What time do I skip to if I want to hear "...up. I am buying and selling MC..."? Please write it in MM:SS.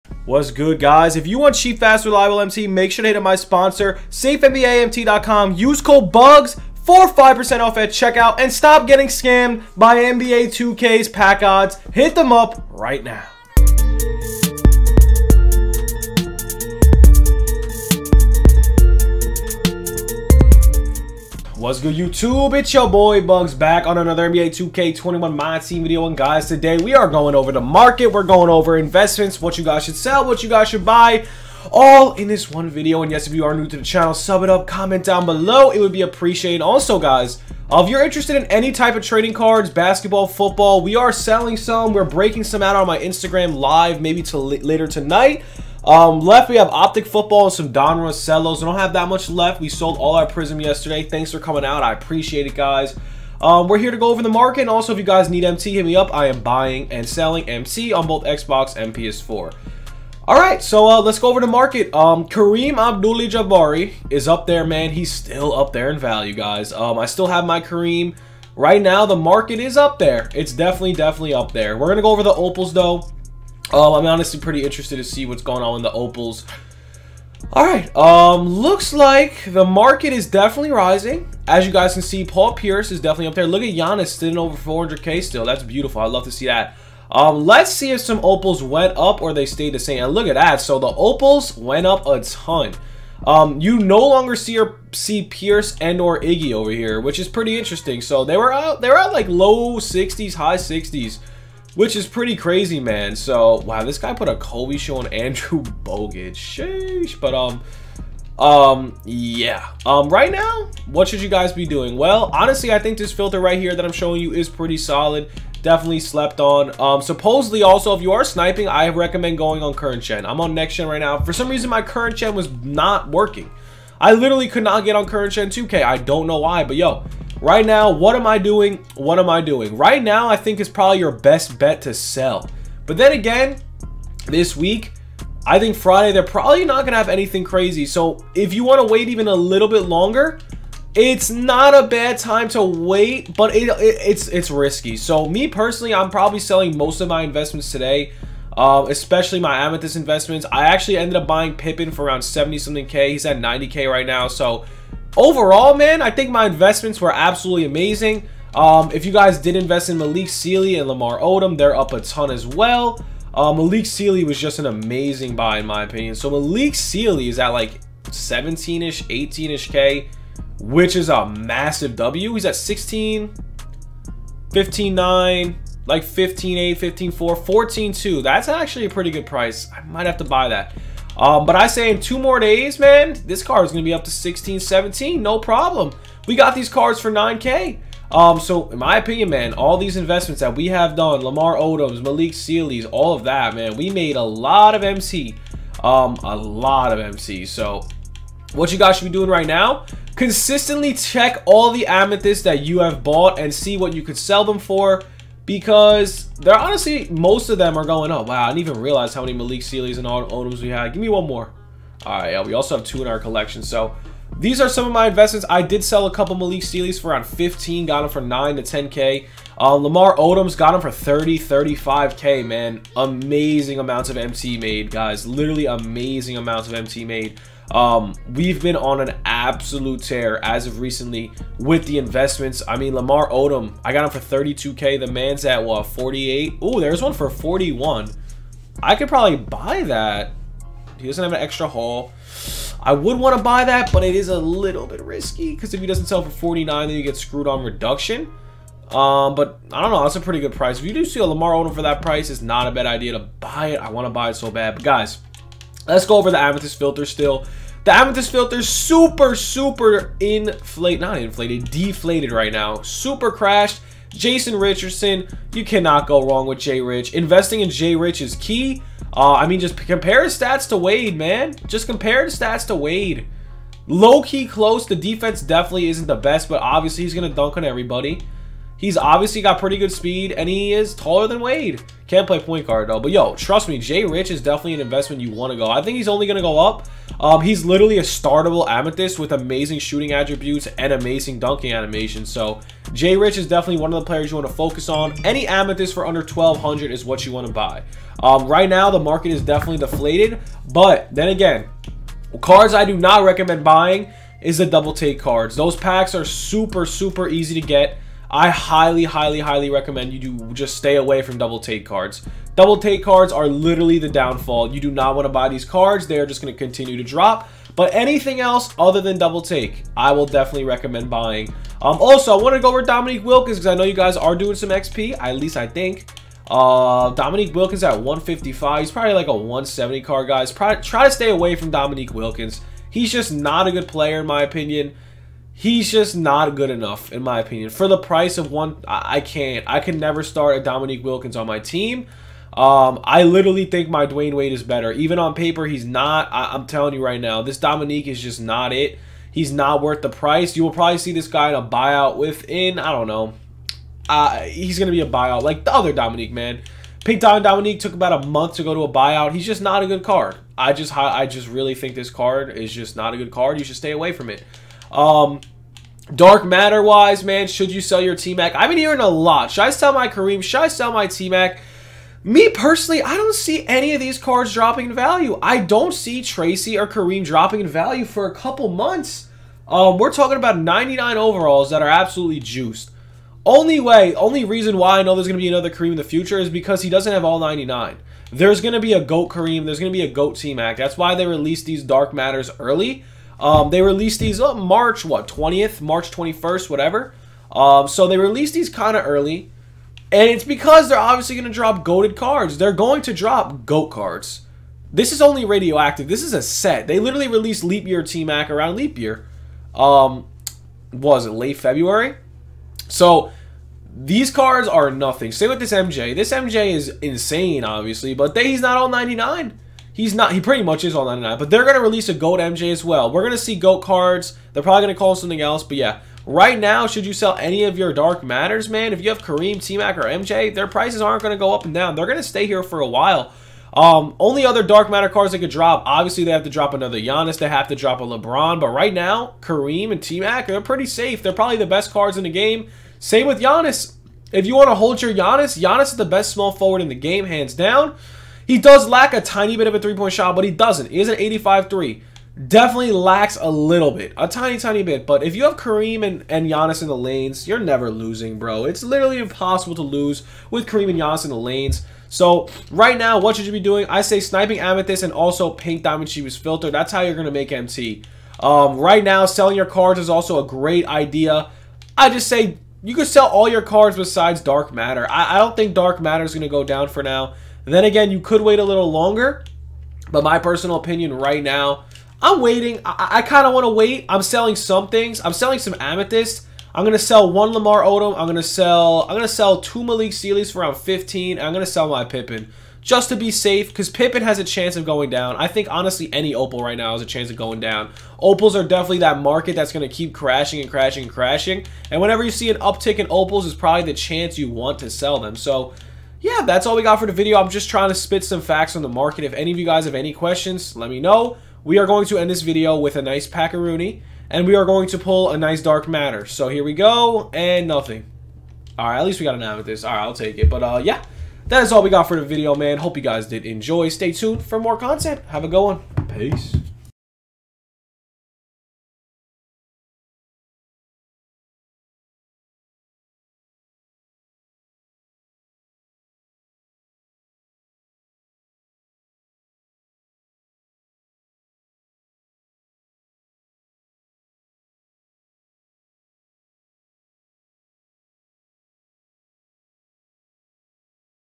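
00:55.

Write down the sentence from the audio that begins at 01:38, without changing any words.
So they were out, they were at like low 60s, high 60s which is pretty crazy, man.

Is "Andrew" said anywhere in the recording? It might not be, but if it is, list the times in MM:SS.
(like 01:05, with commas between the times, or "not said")
01:45.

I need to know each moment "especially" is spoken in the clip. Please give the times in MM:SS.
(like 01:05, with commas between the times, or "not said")
02:28.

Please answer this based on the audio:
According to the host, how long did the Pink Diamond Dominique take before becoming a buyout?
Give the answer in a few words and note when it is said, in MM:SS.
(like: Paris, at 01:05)
about a month, at 05:57.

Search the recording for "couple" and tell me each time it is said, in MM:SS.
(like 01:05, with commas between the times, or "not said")
03:36, 06:18.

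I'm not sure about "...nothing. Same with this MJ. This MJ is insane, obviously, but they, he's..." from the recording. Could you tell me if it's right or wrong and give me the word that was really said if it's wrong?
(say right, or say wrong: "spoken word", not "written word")
right.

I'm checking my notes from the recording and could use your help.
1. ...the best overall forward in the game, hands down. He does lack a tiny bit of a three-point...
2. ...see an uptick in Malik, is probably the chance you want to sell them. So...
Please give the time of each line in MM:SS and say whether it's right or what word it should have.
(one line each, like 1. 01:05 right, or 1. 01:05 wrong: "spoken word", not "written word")
1. 07:25 wrong: "small", not "overall"
2. 08:22 wrong: "Opals", not "Malik".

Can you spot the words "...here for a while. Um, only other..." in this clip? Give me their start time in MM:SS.
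07:12.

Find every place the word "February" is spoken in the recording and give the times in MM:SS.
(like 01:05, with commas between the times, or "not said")
06:51.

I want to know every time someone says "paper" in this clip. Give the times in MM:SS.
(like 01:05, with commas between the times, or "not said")
05:45.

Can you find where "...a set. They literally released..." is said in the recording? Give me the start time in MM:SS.
06:46.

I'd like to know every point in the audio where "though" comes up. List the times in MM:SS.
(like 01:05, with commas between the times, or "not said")
01:12, 04:42.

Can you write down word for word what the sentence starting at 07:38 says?
It's literally impossible to lose with Kareem and Giannis in the lanes.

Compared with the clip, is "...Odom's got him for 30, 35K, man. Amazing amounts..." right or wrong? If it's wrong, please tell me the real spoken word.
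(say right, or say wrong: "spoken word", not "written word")
right.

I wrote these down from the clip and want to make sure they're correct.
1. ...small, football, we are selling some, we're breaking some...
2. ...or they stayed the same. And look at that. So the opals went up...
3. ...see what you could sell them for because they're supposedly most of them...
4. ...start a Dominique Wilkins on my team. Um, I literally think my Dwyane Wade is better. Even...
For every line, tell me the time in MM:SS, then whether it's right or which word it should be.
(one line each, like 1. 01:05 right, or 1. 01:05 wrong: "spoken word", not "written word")
1. 00:39 wrong: "basketball", not "small"
2. 01:29 right
3. 03:23 wrong: "honestly", not "supposedly"
4. 05:40 right.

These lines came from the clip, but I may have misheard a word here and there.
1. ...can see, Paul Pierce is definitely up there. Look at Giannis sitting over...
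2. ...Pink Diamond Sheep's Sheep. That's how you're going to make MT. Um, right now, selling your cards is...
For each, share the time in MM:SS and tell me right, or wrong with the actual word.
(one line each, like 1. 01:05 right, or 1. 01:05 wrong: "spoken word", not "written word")
1. 01:21 right
2. 07:45 wrong: "Filter", not "Sheep".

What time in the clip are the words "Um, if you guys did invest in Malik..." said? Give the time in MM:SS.
02:38.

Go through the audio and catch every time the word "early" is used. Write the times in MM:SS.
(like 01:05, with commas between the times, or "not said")
06:32, 06:39.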